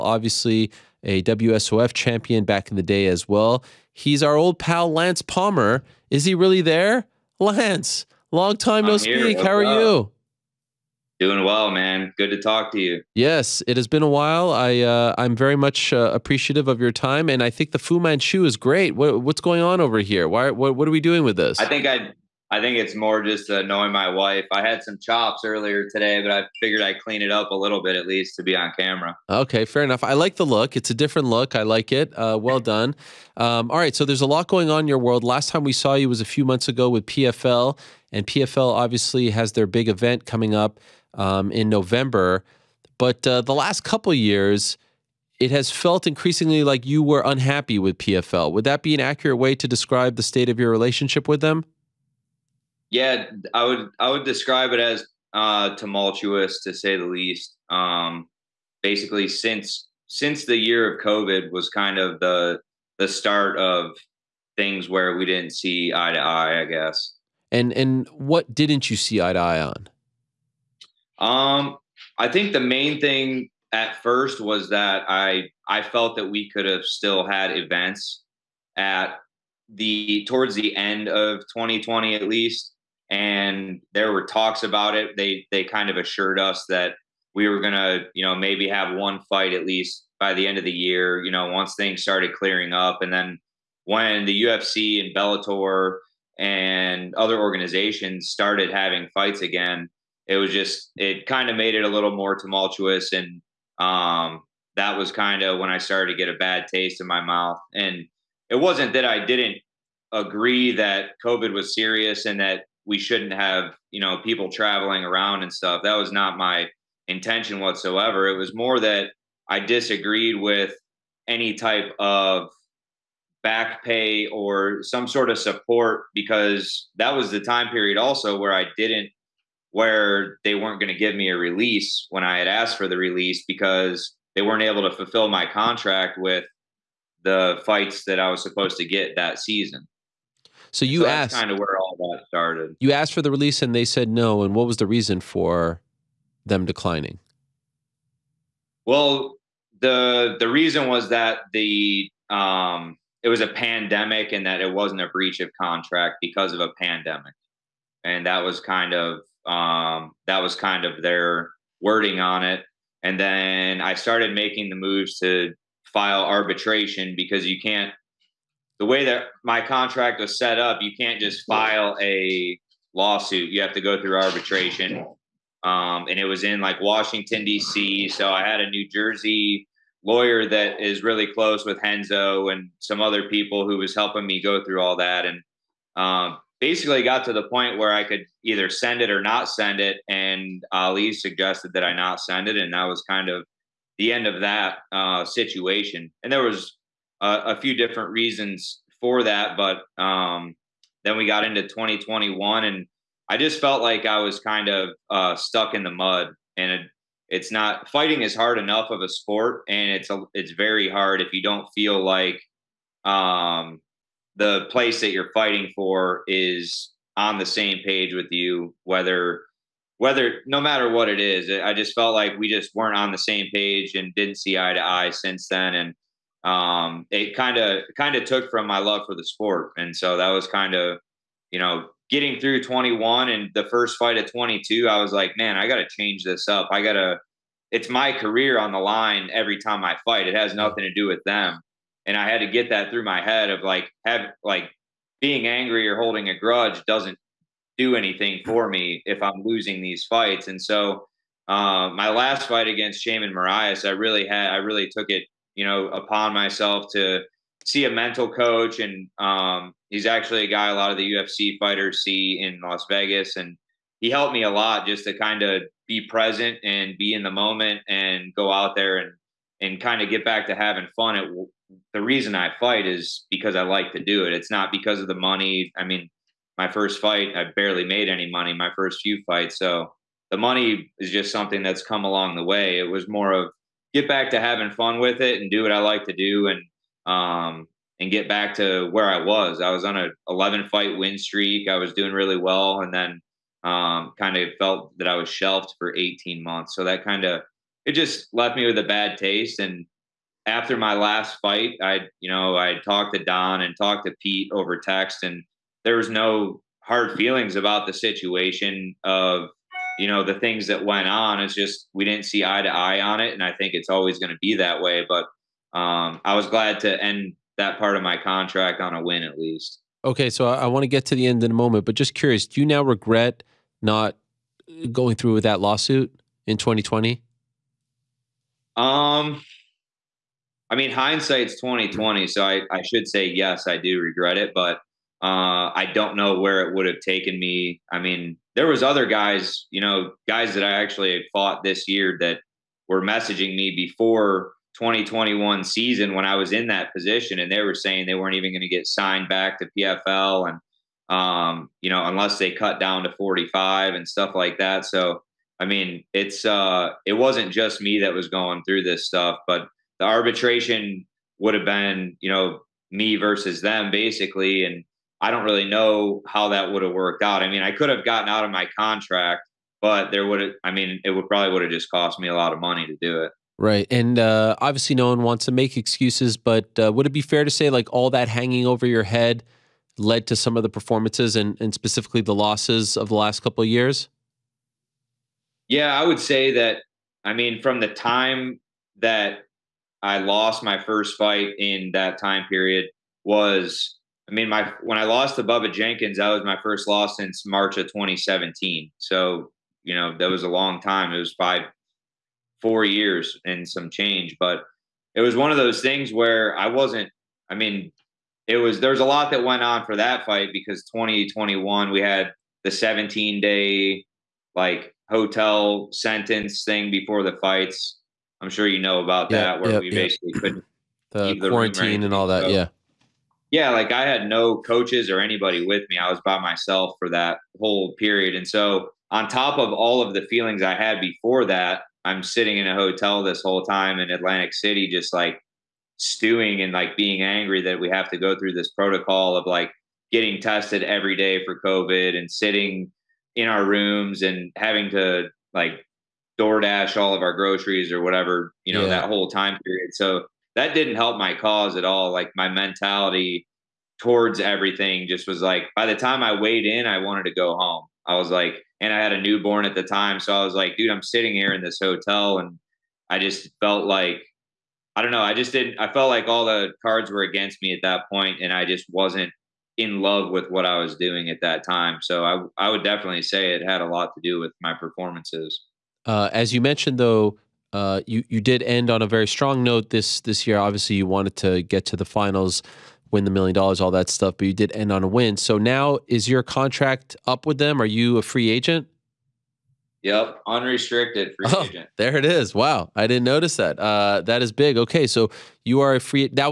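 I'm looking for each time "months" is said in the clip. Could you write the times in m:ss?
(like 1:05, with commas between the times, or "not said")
0:36, 4:56.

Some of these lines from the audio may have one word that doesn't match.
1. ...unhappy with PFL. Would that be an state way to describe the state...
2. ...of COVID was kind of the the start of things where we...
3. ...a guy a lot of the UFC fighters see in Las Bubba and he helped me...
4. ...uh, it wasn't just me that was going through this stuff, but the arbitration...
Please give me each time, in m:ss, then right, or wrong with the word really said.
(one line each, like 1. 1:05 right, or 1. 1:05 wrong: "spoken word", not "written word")
1. 0:47 wrong: "accurate", not "state"
2. 1:00 right
3. 4:20 wrong: "Vegas", not "Bubba"
4. 5:56 right.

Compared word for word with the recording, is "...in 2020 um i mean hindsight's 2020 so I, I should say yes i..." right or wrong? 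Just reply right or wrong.
right.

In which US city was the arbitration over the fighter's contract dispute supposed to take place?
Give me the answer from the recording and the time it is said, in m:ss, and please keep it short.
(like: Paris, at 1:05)
Washington D.C., at 2:56.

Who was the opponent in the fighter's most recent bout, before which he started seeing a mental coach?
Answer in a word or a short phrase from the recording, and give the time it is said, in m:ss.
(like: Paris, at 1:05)
Sheymon Moraes, at 4:13.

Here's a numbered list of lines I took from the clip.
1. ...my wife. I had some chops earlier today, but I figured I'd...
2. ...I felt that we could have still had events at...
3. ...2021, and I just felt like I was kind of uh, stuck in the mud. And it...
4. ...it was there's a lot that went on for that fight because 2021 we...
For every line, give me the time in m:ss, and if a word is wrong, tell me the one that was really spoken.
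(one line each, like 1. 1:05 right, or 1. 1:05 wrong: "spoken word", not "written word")
1. 0:23 right
2. 1:15 right
3. 3:21 right
4. 6:48 right.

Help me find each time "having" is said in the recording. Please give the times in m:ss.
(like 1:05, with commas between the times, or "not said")
1:38, 4:30, 4:44, 7:24.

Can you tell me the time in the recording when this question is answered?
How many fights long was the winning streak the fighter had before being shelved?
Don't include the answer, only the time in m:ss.
4:50.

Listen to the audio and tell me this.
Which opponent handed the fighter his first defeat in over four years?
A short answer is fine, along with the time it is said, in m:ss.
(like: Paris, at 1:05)
Bubba Jenkins, at 6:35.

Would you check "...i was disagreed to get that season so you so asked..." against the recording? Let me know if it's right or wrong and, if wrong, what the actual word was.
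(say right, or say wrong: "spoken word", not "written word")
wrong: "supposed", not "disagreed".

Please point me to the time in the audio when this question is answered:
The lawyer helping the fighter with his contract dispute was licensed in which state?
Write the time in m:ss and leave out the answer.
2:58.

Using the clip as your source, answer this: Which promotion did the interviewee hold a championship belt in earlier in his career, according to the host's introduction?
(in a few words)
WSOF.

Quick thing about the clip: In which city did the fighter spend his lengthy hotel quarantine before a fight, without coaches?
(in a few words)
Atlantic City.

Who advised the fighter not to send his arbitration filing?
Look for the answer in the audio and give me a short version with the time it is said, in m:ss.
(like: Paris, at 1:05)
Ali, at 3:10.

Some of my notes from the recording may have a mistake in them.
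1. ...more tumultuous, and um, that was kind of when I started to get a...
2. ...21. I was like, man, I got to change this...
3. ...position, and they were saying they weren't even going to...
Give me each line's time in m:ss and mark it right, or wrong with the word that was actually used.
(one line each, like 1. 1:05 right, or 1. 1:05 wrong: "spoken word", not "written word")
1. 1:42 right
2. 3:54 wrong: "22", not "21"
3. 5:46 right.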